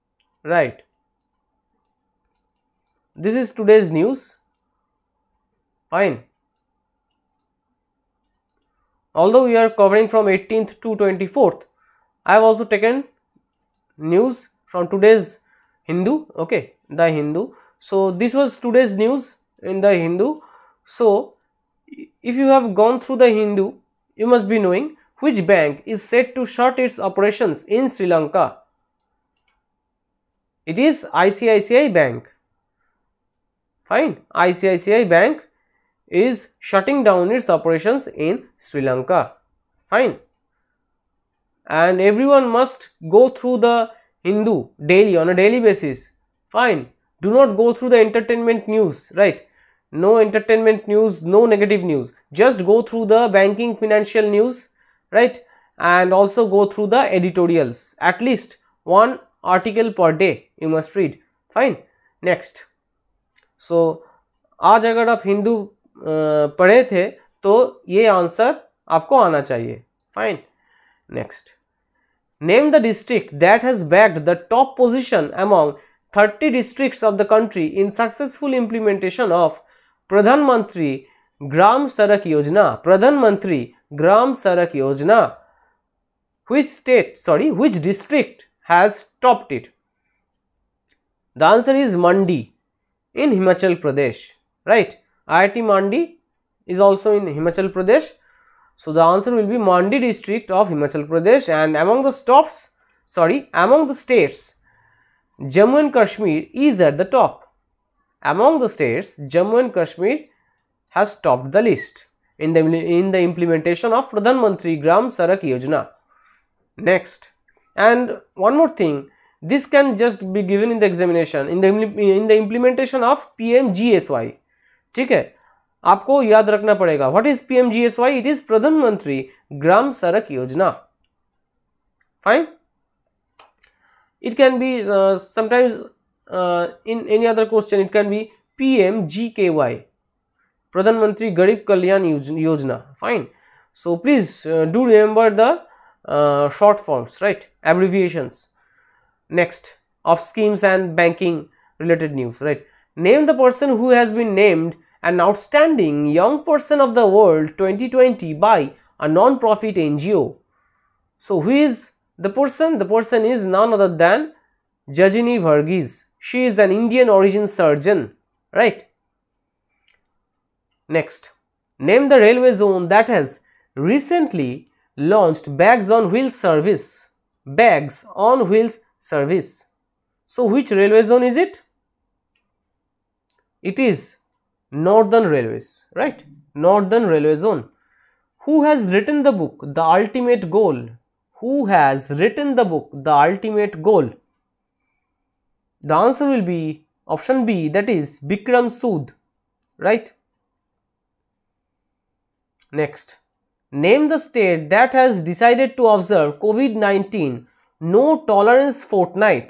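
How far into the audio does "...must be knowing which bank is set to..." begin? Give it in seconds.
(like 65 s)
24 s.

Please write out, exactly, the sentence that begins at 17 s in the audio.
So this was today's news in the Hindu.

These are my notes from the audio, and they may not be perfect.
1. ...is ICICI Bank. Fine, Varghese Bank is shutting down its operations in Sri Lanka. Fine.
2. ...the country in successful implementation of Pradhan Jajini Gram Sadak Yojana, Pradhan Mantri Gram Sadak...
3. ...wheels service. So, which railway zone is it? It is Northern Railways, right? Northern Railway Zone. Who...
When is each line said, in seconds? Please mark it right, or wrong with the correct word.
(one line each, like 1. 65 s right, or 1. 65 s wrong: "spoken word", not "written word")
1. 30 s wrong: "ICICI", not "Varghese"
2. 77 s wrong: "Mantri", not "Jajini"
3. 178 s right.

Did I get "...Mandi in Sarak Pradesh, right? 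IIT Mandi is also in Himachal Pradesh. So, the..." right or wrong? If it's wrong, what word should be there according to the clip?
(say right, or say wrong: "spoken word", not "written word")
wrong: "Himachal", not "Sarak".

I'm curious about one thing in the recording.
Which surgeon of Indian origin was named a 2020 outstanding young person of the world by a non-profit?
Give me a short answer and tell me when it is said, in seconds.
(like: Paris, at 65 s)
Jajini Varghese, at 164 s.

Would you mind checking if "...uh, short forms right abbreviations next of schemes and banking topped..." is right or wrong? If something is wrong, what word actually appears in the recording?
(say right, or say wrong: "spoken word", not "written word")
wrong: "related", not "topped".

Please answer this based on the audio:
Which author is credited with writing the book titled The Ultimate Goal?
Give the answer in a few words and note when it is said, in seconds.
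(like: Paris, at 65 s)
Bikram Sood, at 198 s.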